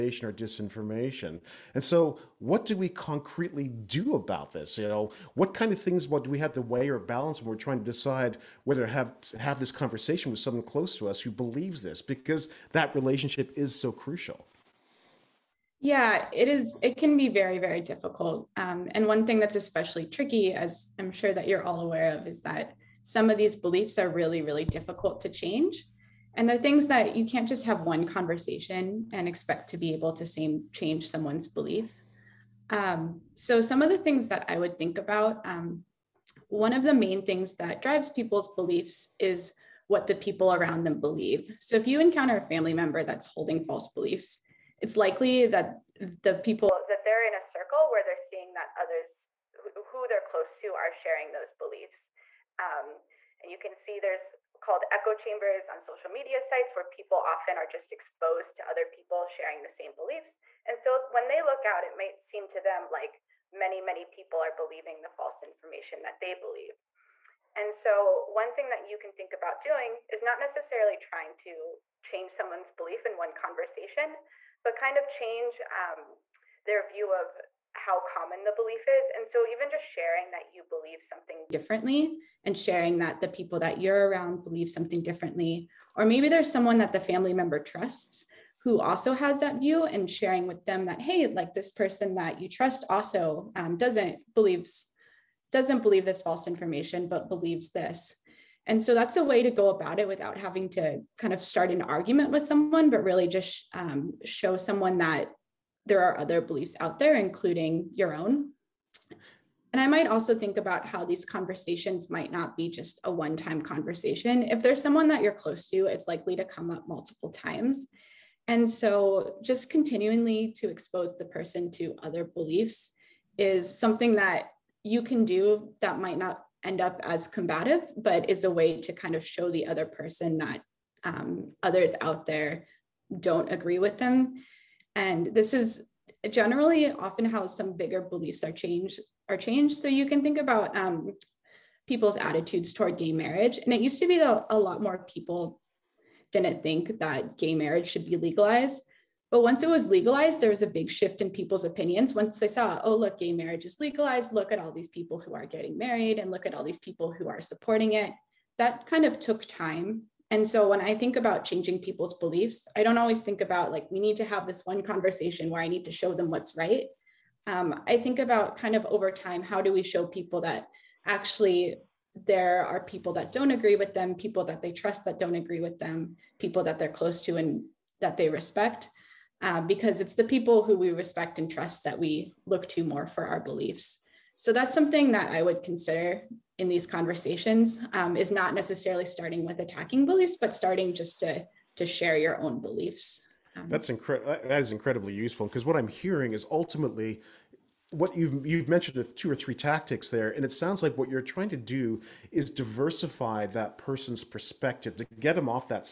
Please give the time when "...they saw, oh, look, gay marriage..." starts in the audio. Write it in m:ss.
2:32.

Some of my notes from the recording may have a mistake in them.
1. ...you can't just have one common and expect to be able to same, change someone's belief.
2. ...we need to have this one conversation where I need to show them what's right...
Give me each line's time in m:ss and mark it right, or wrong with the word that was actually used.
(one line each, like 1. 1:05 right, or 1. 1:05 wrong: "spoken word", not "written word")
1. 0:27 wrong: "conversation", not "common"
2. 2:43 right.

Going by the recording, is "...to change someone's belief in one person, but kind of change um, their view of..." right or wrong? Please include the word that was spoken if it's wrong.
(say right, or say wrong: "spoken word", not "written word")
wrong: "conversation", not "person".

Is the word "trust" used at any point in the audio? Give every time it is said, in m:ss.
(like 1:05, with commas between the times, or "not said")
1:27, 1:32, 2:54, 3:01.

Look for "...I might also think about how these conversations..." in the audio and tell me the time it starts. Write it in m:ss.
1:49.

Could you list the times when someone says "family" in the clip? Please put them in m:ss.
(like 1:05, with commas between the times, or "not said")
0:42, 1:27.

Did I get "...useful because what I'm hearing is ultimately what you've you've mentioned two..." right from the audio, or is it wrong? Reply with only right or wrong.
right.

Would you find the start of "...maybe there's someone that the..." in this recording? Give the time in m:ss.
1:26.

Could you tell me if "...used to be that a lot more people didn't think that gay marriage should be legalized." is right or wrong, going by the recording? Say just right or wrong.
right.